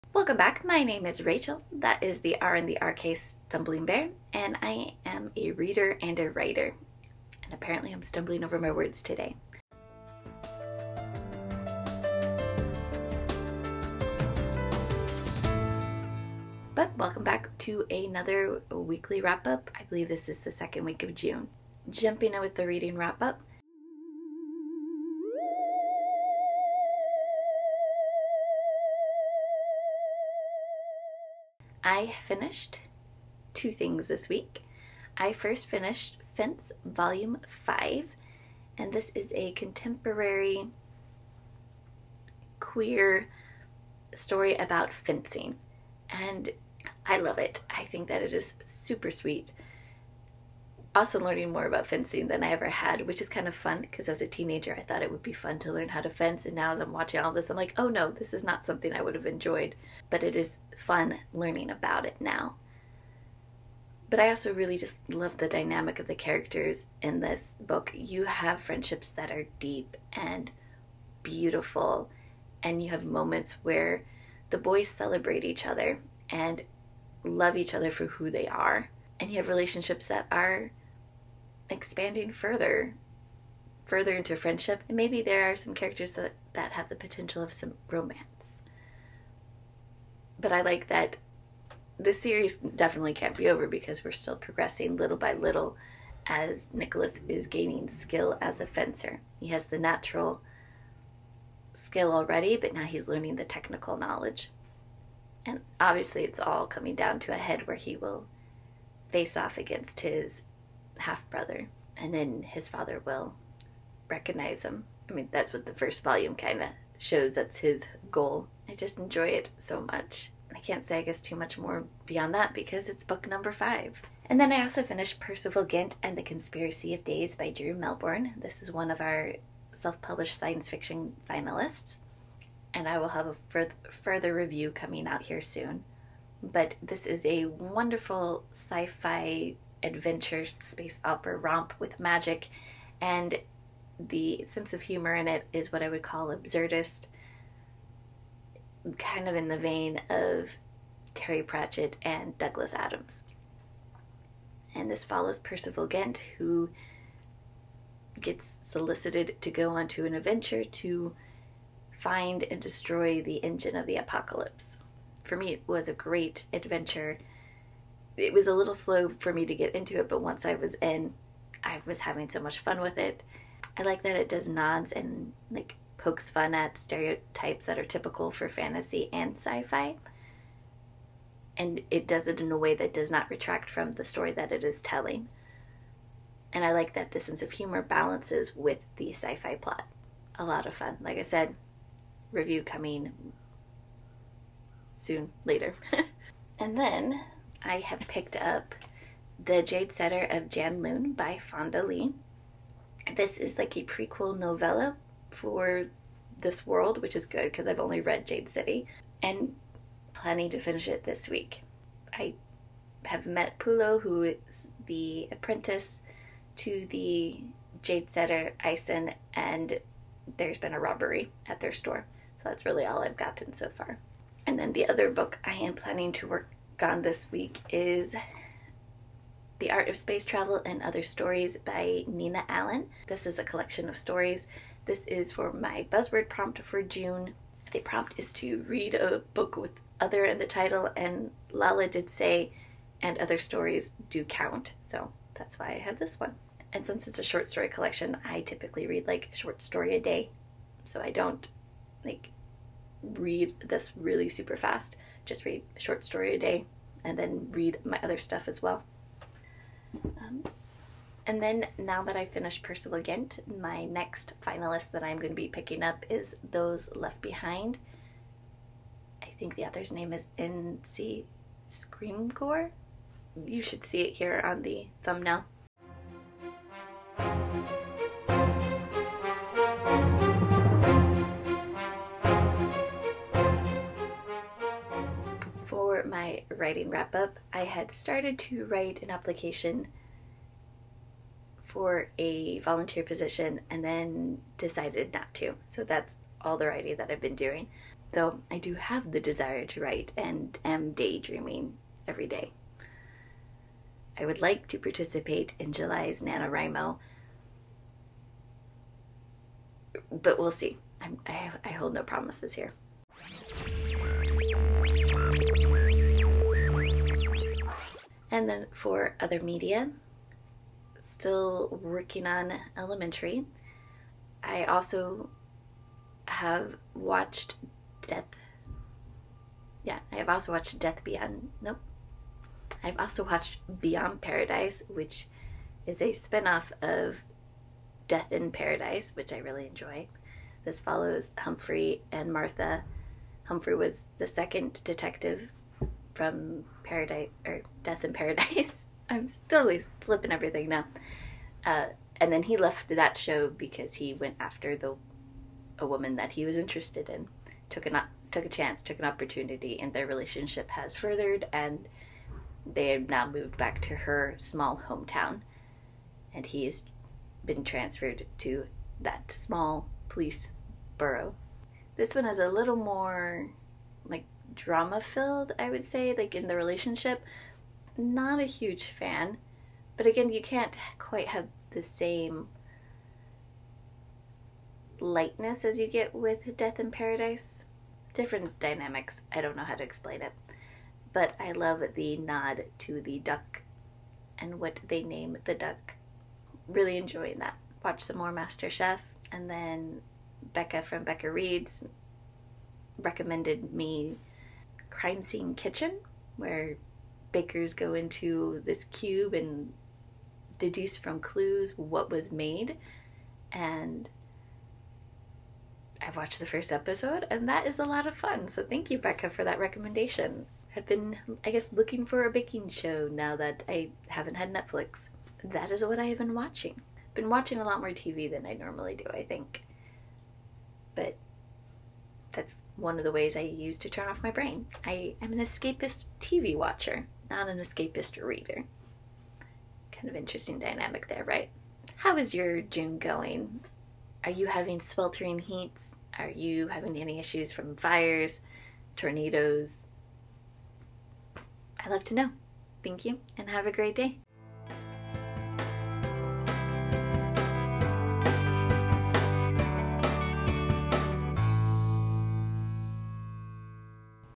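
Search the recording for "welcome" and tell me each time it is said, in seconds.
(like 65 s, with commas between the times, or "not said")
0 s, 16 s.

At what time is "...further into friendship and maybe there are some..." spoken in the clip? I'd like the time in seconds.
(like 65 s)
83 s.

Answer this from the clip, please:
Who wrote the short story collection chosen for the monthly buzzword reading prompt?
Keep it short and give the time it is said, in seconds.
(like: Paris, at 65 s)
Nina Allan, at 232 s.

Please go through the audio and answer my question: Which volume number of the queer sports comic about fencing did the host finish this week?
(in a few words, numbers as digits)
5.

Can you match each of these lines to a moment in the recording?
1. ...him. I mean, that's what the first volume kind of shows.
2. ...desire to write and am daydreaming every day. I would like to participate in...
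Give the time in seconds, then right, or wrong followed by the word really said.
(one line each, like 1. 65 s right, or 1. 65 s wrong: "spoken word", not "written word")
1. 114 s right
2. 299 s right.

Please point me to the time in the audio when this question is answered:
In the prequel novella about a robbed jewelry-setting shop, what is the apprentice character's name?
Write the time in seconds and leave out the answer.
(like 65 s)
213 s.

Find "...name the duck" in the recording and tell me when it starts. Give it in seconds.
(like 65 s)
395 s.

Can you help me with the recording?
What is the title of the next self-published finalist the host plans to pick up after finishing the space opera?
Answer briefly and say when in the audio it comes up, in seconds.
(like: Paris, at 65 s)
Those Left Behind, at 266 s.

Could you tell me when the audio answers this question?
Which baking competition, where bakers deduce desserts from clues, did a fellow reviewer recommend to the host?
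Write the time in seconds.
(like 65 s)
404 s.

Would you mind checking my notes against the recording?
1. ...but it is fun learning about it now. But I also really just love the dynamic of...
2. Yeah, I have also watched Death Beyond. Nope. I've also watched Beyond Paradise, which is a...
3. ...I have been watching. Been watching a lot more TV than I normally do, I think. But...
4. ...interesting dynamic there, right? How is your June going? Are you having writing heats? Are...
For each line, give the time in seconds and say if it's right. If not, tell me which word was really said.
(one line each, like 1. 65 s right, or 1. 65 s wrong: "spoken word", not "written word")
1. 60 s right
2. 329 s right
3. 425 s right
4. 440 s wrong: "sweltering", not "writing".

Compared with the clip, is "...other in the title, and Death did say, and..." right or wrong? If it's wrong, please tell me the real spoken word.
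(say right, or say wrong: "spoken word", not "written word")
wrong: "Lala", not "Death".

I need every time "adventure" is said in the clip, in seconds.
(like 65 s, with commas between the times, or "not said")
139 s, 160 s, 166 s.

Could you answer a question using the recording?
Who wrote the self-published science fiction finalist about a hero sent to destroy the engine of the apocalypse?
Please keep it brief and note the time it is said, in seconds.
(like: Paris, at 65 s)
Drew Melbourne, at 127 s.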